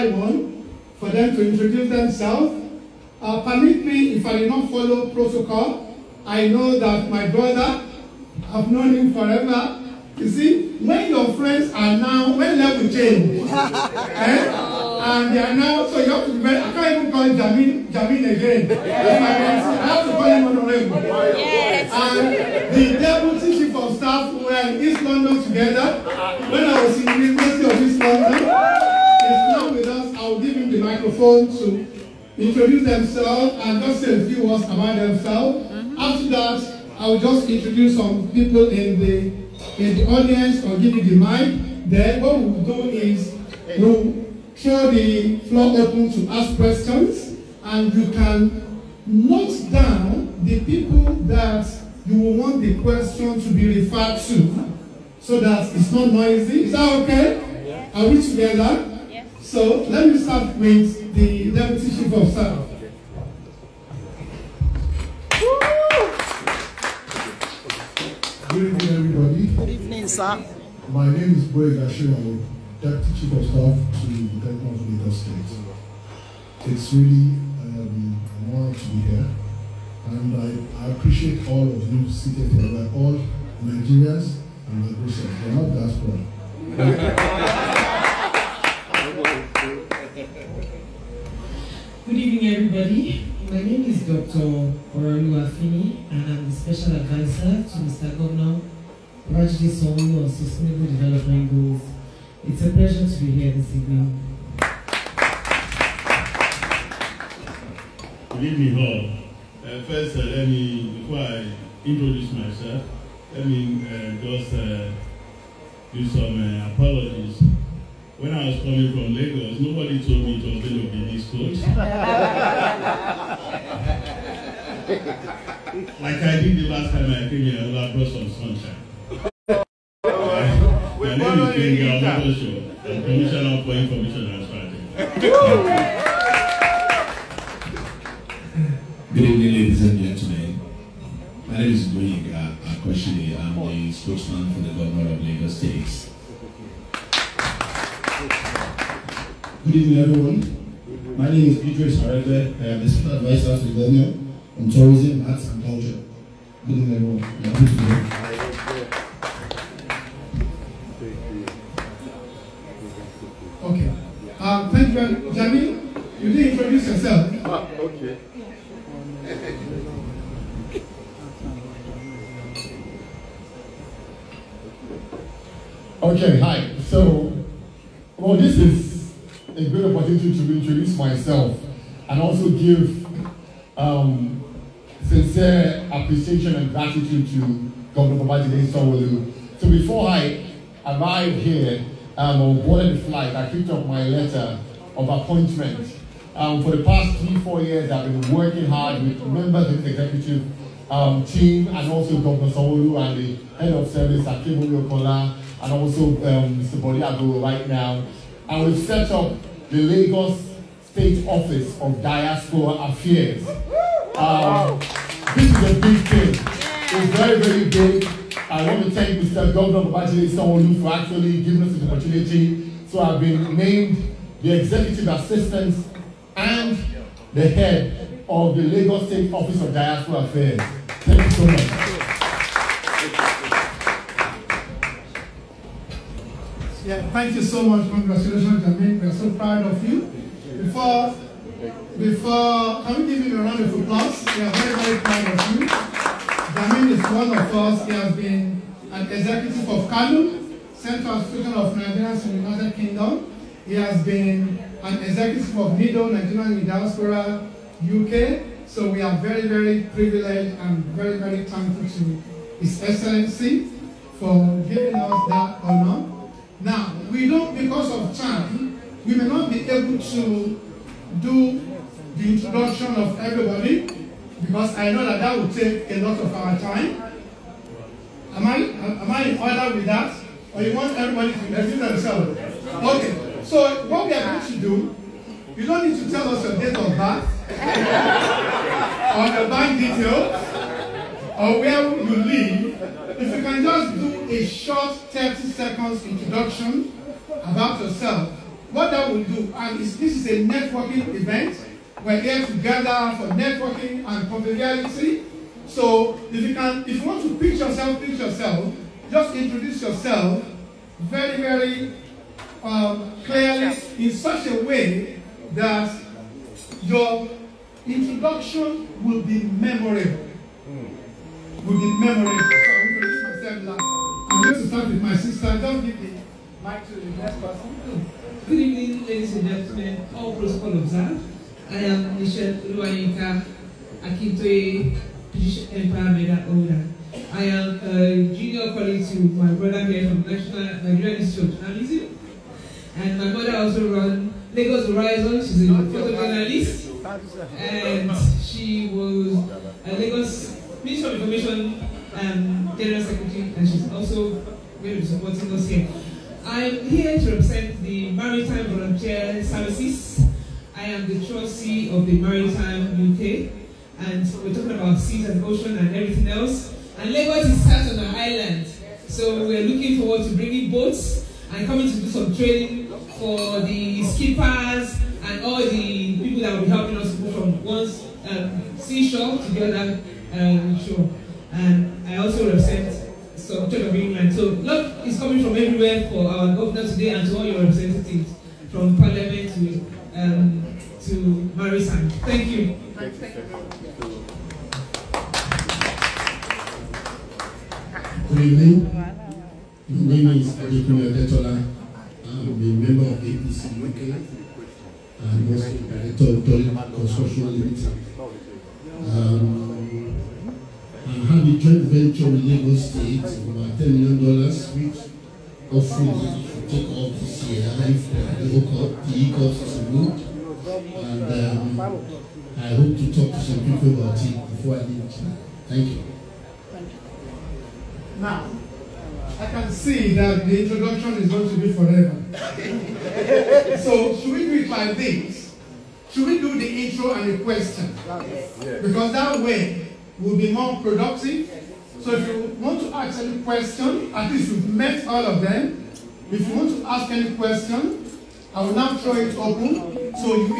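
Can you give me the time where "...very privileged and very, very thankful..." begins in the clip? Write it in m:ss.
4:19.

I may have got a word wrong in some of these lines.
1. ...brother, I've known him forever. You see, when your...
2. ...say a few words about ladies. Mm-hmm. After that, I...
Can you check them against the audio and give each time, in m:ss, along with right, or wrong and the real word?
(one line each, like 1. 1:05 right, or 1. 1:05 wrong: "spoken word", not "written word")
1. 0:07 right
2. 0:33 wrong: "themselves", not "ladies".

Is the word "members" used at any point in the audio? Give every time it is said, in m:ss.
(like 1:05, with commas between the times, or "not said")
3:19, 6:42.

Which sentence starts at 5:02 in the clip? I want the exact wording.
We're here to gather for networking and conviviality.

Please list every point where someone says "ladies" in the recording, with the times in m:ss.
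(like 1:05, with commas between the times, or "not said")
2:19, 5:29.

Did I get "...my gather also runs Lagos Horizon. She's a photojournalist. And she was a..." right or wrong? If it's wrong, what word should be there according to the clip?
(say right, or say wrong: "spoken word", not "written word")
wrong: "mother", not "gather".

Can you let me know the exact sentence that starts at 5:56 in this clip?
I'm here to represent the Maritime Volunteer Services.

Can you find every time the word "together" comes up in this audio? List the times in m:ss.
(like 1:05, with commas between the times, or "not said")
0:25, 0:58.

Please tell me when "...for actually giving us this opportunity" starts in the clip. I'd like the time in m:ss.
3:40.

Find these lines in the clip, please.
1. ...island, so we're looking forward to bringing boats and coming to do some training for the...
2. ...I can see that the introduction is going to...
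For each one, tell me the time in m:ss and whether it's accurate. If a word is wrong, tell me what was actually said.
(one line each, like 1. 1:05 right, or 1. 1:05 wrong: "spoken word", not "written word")
1. 6:08 right
2. 7:09 right.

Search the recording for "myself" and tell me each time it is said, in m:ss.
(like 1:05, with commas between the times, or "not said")
1:52, 3:00, 5:23.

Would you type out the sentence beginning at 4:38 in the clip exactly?
Am I, am I in order with that?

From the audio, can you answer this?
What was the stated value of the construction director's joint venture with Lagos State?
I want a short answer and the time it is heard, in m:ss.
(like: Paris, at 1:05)
$10 million, at 6:53.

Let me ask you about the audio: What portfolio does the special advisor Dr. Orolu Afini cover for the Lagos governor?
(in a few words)
Sustainable Development Goals.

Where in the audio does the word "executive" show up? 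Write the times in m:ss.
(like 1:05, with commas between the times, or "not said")
3:19, 3:44, 4:09, 4:15.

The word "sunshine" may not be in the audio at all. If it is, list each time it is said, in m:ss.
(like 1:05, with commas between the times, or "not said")
2:08.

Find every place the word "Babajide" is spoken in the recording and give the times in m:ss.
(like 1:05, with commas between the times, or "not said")
3:08, 3:39.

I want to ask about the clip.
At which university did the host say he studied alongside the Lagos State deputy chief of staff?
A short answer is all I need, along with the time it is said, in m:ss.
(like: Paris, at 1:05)
University of East London, at 0:27.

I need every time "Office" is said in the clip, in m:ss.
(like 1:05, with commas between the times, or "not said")
3:31, 3:49.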